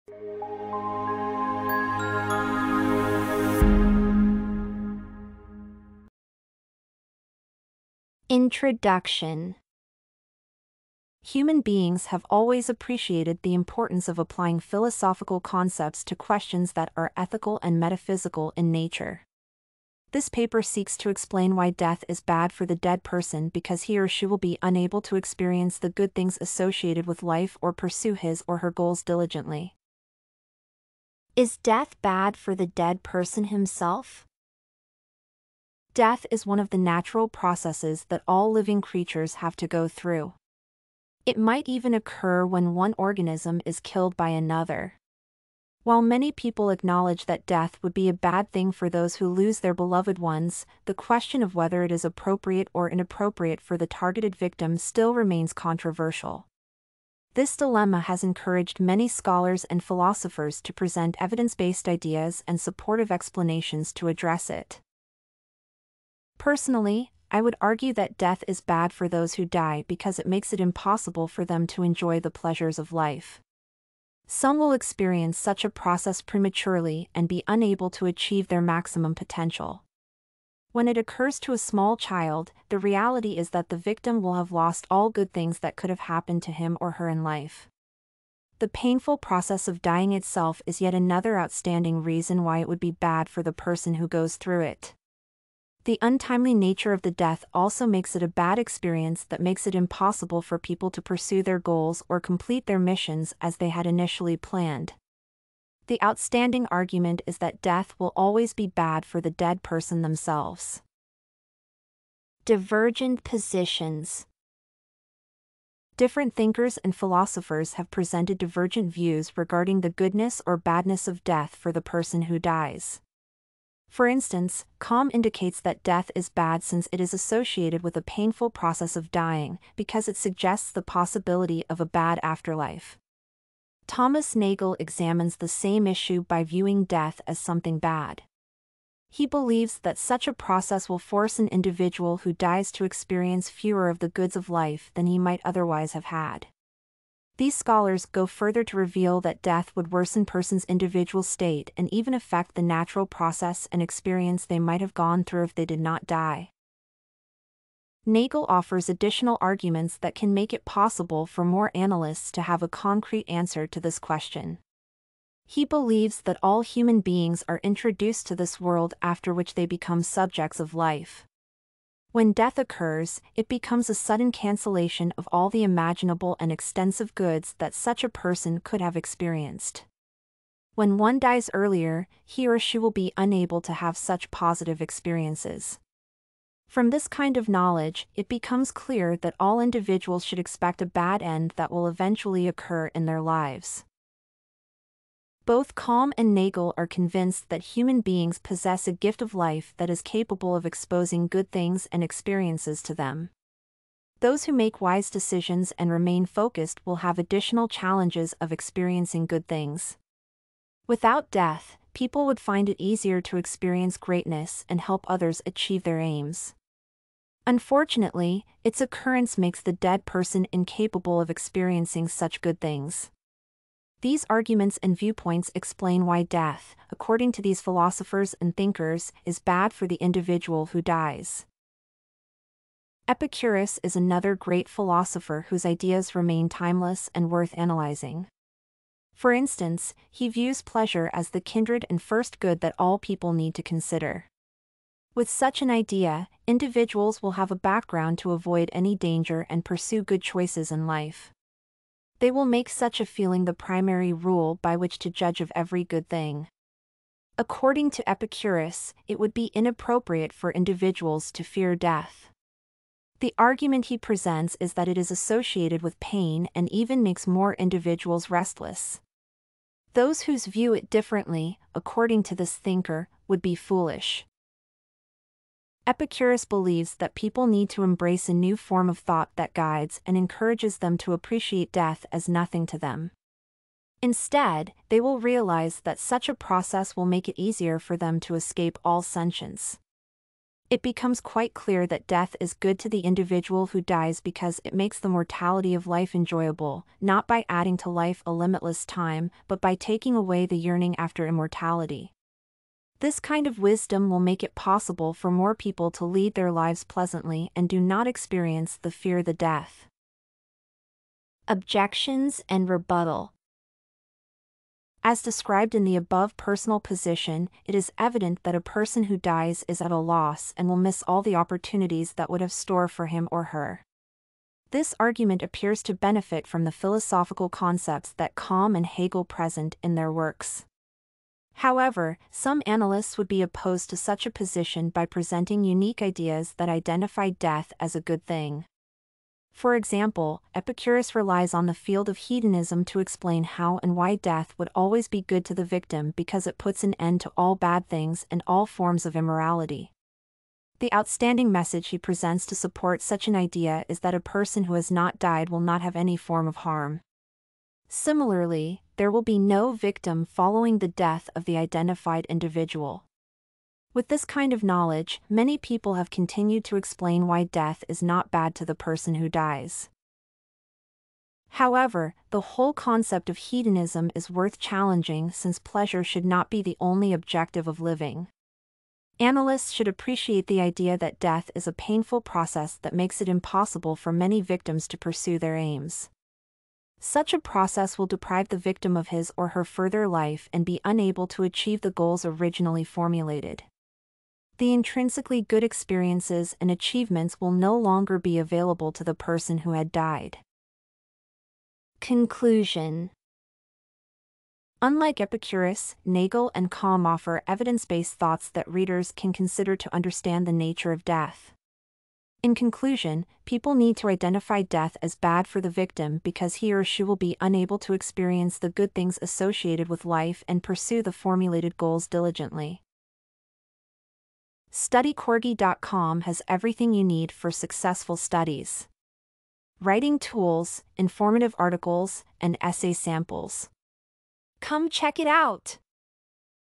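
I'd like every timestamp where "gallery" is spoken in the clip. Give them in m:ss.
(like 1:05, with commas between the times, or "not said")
not said.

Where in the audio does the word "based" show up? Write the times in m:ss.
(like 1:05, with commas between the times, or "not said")
1:01, 6:47.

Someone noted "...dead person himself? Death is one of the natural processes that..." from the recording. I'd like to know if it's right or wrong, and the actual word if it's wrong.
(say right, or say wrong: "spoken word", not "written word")
right.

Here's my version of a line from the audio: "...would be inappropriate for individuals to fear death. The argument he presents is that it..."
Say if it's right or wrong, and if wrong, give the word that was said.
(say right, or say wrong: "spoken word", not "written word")
right.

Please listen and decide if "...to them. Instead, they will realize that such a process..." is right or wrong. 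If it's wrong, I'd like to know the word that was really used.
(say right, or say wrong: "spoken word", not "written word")
right.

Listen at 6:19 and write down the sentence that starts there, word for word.
Analysts should appreciate the idea that death is a painful process that makes it impossible for many victims to pursue their aims.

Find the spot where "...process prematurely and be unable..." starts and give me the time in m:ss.
1:15.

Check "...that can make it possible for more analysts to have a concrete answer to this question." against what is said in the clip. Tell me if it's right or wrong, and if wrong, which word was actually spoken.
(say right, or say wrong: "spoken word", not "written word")
right.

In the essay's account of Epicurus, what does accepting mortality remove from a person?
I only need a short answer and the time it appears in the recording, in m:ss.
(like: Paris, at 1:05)
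yearning after immortality, at 5:00.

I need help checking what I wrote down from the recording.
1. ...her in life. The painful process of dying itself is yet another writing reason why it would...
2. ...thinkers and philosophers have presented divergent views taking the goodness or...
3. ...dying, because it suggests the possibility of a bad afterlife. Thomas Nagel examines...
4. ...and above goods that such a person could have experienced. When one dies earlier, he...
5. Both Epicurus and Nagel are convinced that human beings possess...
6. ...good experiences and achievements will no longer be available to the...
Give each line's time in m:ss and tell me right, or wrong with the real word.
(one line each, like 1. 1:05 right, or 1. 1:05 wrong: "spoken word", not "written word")
1. 1:26 wrong: "outstanding", not "writing"
2. 1:56 wrong: "regarding", not "taking"
3. 2:09 right
4. 2:56 wrong: "extensive", not "above"
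5. 3:15 wrong: "Kamm", not "Epicurus"
6. 6:35 right.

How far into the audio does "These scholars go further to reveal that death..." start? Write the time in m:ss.
2:27.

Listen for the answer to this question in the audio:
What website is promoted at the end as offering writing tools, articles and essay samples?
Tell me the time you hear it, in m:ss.
7:04.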